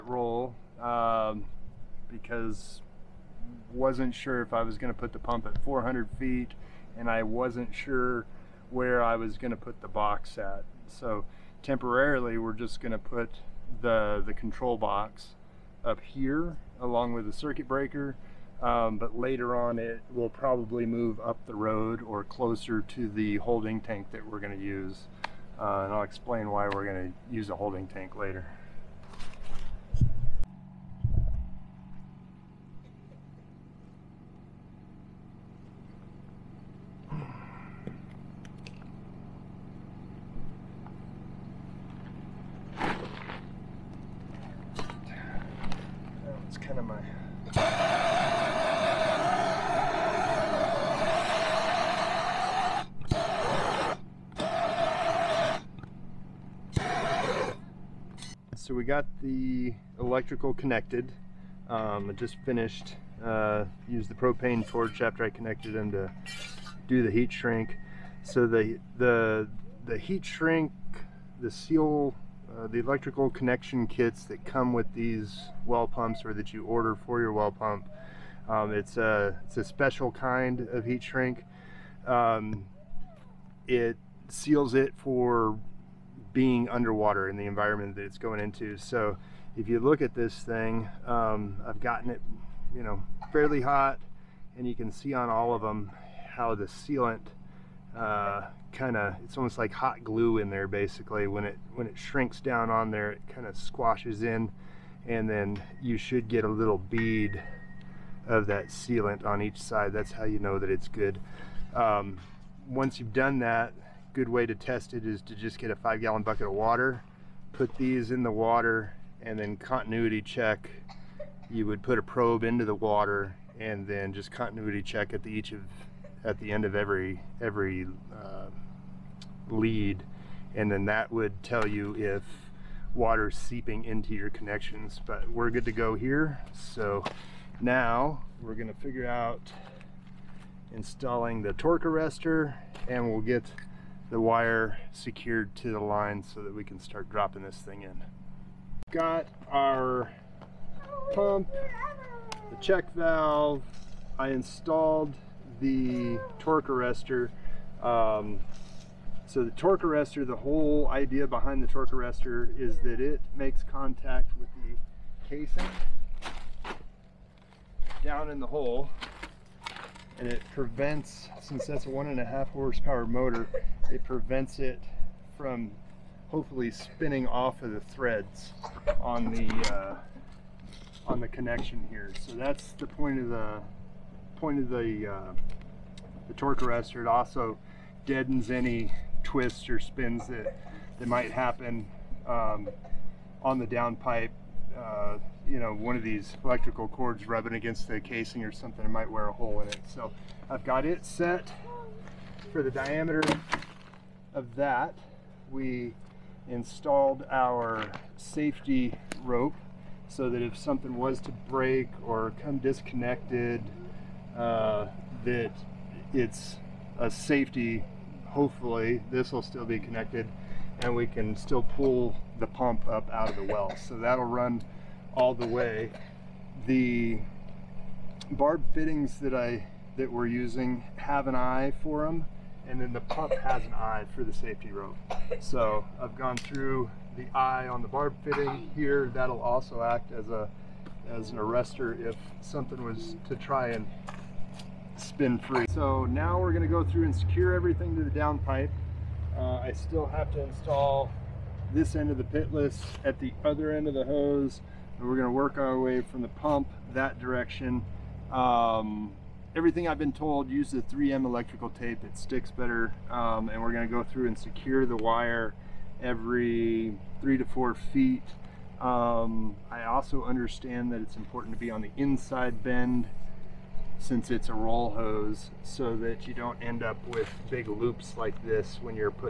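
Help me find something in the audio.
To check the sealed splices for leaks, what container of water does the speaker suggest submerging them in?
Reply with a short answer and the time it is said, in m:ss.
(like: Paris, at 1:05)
5 gallon bucket, at 1:55.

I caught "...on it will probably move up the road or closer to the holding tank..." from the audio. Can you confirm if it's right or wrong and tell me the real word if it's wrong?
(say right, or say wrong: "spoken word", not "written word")
right.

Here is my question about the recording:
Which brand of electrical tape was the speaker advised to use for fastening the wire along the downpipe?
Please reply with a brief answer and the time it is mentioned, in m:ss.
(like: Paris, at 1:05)
3M, at 4:20.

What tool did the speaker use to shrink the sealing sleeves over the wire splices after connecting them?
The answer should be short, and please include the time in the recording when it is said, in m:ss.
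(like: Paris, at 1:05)
propane torch, at 1:04.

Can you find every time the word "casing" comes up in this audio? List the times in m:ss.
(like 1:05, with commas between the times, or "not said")
2:45, 3:17.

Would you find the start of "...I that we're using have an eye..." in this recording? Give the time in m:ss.
3:49.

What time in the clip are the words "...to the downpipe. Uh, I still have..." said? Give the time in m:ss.
4:07.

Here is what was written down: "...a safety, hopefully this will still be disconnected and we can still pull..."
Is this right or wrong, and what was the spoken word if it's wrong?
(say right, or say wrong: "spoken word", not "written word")
wrong: "connected", not "disconnected".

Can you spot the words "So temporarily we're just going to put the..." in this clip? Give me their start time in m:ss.
0:10.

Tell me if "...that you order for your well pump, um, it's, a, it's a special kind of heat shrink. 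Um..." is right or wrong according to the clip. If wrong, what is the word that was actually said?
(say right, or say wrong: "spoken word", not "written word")
right.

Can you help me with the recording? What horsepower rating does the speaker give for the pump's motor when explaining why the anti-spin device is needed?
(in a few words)
1.5 horsepower.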